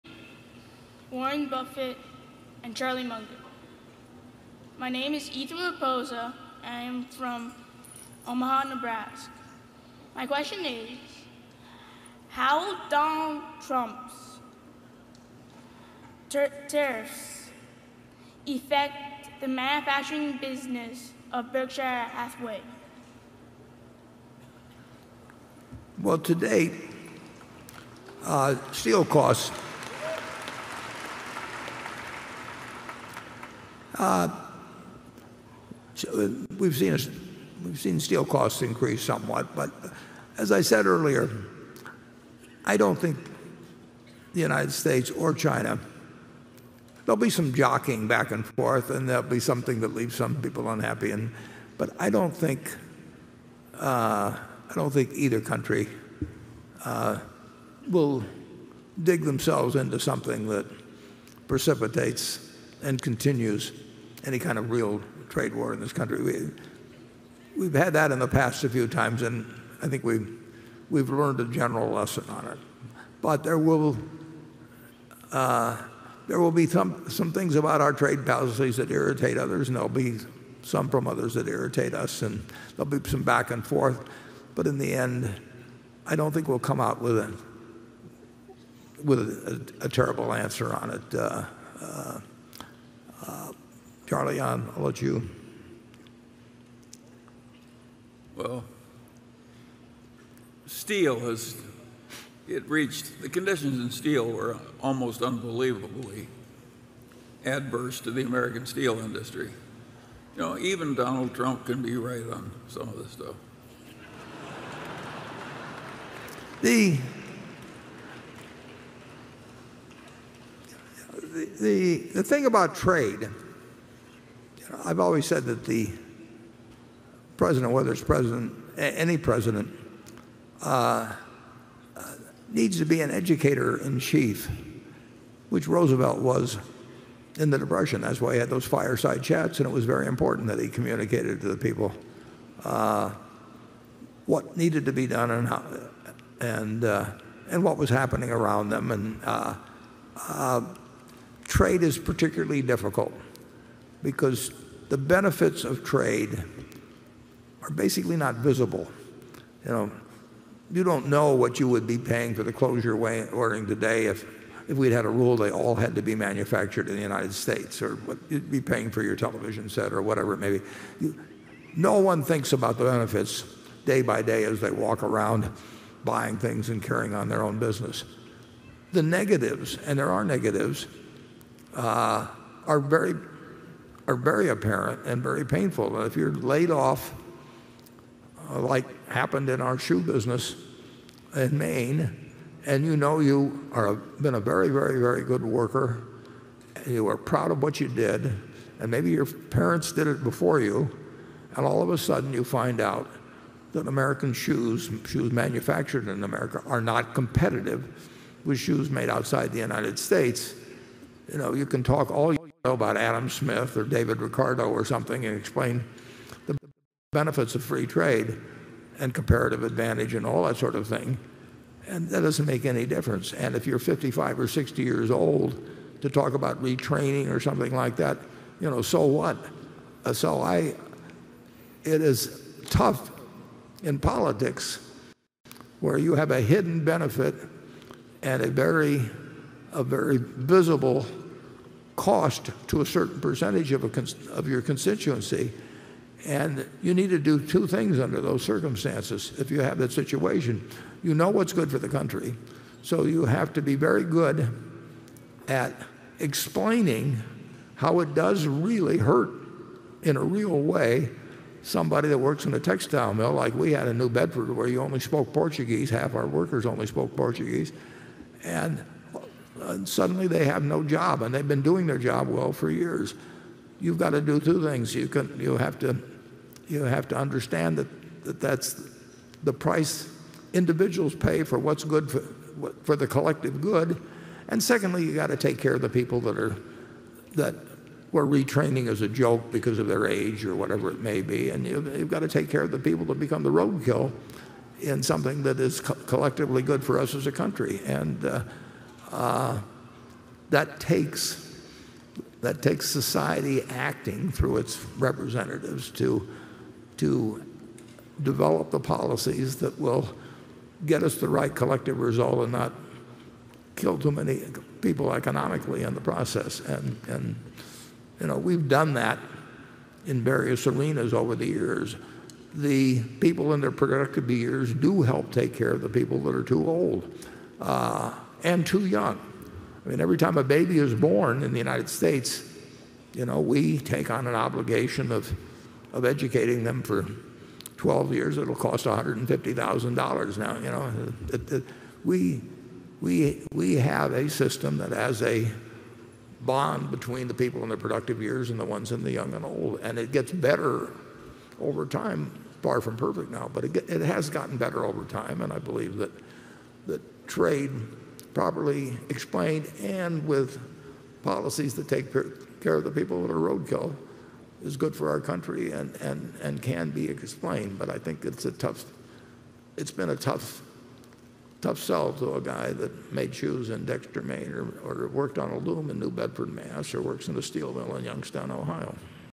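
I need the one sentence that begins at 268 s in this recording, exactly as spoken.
And and suddenly they have no job, and they've been doing their job well for years.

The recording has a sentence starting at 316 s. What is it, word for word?
And, and you know, we've done that in various arenas over the years.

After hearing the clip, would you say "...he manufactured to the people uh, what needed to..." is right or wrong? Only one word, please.
wrong.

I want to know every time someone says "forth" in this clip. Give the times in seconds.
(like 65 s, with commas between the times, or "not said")
48 s, 83 s.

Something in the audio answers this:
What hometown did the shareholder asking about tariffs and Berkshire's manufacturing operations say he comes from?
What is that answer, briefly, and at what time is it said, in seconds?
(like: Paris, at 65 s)
Omaha, Nebraska, at 8 s.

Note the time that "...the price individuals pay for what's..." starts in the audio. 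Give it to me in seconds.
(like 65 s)
279 s.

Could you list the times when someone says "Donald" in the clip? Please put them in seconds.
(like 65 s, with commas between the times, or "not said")
12 s, 110 s.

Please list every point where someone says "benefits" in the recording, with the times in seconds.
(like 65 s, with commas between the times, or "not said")
154 s, 172 s, 217 s, 236 s.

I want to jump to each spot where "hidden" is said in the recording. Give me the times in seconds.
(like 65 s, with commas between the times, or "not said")
236 s.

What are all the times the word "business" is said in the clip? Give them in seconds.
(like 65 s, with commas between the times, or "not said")
20 s, 177 s, 190 s.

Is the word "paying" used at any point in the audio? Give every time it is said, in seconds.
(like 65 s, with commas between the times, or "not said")
161 s, 168 s.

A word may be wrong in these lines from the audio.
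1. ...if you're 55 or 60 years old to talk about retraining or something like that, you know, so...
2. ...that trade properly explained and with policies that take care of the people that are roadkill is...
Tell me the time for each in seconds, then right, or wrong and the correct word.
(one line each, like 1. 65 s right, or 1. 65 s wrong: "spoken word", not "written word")
1. 223 s right
2. 356 s right.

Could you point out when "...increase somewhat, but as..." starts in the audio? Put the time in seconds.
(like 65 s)
38 s.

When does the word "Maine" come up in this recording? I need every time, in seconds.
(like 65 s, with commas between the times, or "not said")
191 s, 374 s.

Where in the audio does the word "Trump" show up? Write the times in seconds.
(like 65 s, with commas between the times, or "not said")
13 s, 111 s.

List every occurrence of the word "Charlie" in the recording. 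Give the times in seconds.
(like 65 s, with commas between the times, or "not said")
2 s, 94 s.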